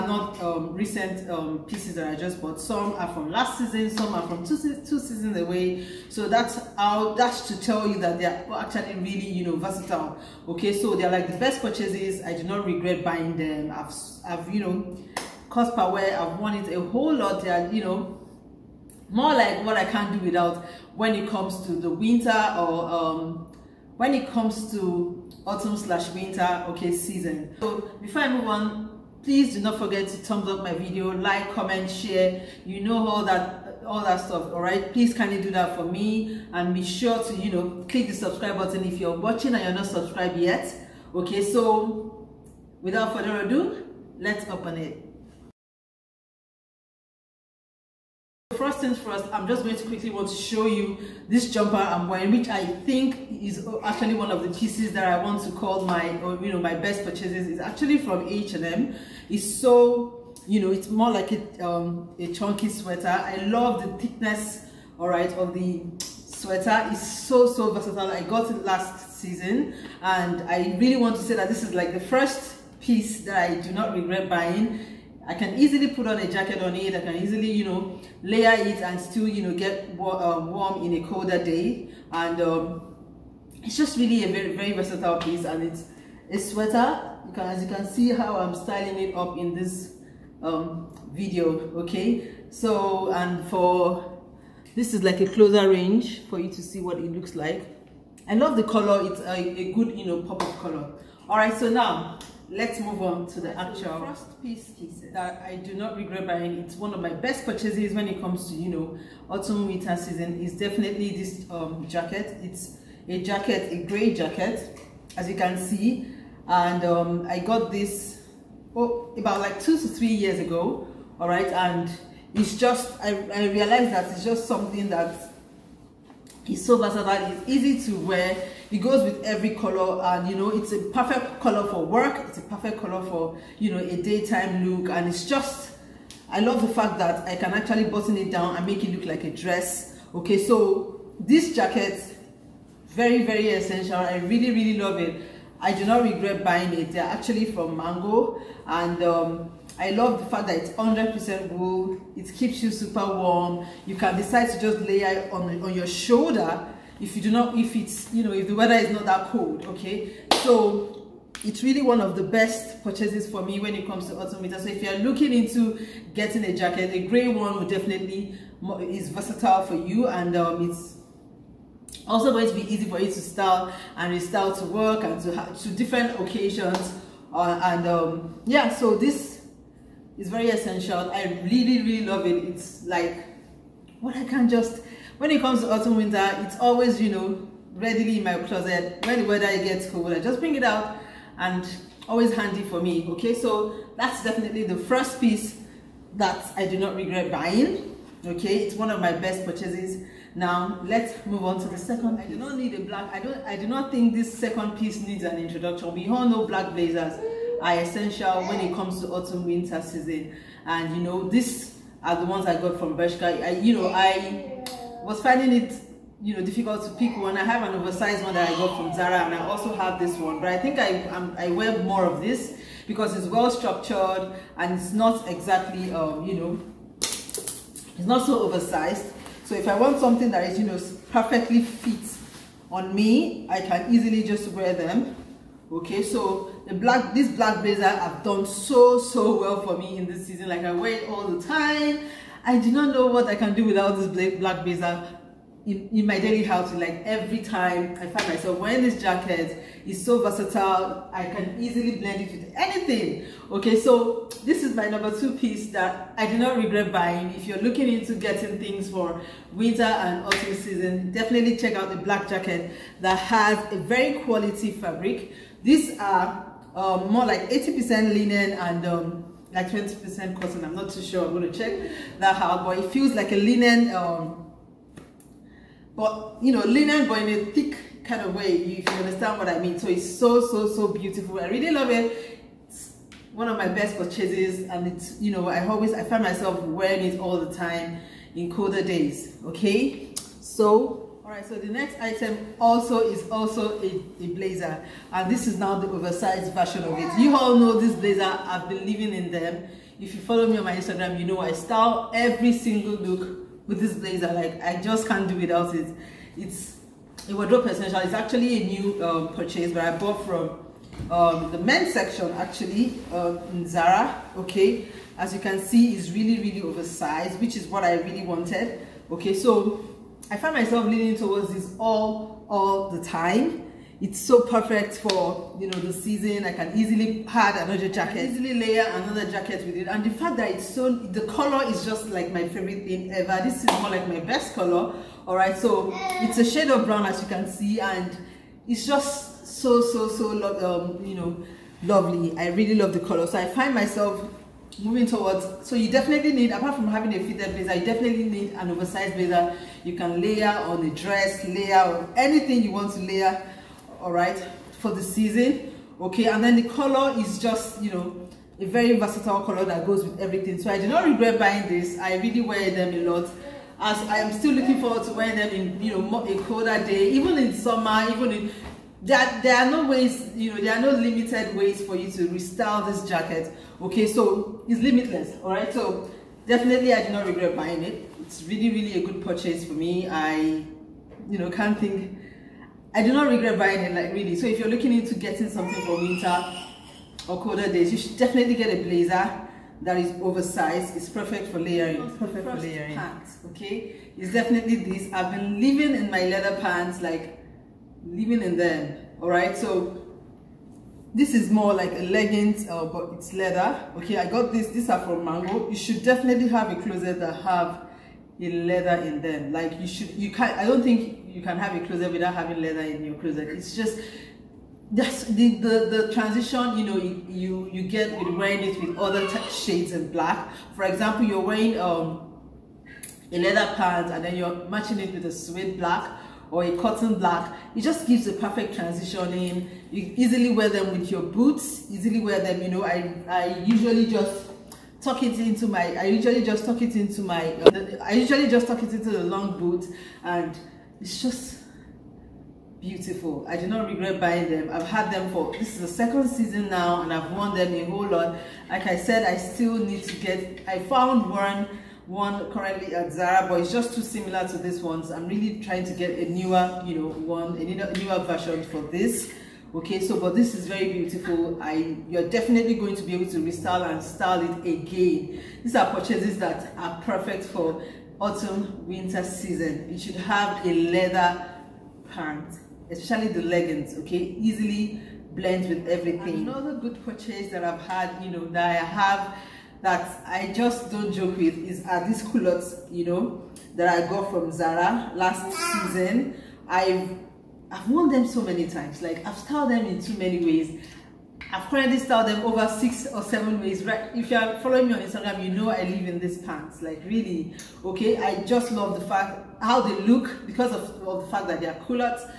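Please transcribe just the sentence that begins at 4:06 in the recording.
Like every time I find myself wearing this jacket, it's so versatile.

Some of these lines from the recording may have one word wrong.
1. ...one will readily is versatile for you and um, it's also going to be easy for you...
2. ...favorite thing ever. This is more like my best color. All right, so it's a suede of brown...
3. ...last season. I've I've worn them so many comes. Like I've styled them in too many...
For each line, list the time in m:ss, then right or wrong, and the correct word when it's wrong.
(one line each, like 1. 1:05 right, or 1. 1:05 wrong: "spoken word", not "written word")
1. 2:47 wrong: "definitely", not "readily"
2. 5:32 wrong: "shade", not "suede"
3. 8:05 wrong: "times", not "comes".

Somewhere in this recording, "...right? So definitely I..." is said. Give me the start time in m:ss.
6:15.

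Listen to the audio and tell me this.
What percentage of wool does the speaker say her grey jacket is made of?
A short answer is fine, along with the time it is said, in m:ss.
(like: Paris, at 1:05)
100%, at 2:30.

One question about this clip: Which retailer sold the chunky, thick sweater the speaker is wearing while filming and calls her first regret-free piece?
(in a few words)
H&M.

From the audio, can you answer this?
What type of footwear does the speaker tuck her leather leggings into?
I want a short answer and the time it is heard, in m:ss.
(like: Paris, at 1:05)
long boot, at 7:19.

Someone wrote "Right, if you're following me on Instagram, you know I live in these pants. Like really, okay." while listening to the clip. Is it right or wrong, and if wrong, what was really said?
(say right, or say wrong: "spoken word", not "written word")
right.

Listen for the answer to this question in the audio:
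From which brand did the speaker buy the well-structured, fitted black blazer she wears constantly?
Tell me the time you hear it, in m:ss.
3:32.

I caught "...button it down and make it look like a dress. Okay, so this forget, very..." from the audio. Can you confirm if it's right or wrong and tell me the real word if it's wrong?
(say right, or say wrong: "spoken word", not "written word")
wrong: "jacket", not "forget".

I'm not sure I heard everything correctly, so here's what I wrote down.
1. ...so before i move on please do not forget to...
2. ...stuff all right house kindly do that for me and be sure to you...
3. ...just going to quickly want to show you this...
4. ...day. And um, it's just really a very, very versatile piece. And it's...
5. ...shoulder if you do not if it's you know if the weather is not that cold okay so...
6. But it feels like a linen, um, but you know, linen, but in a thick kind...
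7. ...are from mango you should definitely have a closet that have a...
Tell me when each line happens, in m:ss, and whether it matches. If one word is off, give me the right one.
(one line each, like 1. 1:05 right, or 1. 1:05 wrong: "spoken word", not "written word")
1. 0:27 right
2. 0:34 wrong: "please", not "house"
3. 0:49 right
4. 1:21 right
5. 2:35 right
6. 4:32 right
7. 6:44 right.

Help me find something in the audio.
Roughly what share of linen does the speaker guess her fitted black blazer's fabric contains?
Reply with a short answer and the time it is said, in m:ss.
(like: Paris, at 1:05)
80%, at 4:27.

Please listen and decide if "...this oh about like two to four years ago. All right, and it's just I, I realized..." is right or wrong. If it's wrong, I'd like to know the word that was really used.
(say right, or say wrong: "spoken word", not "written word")
wrong: "three", not "four".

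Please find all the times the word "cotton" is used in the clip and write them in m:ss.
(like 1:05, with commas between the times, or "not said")
4:30, 7:06.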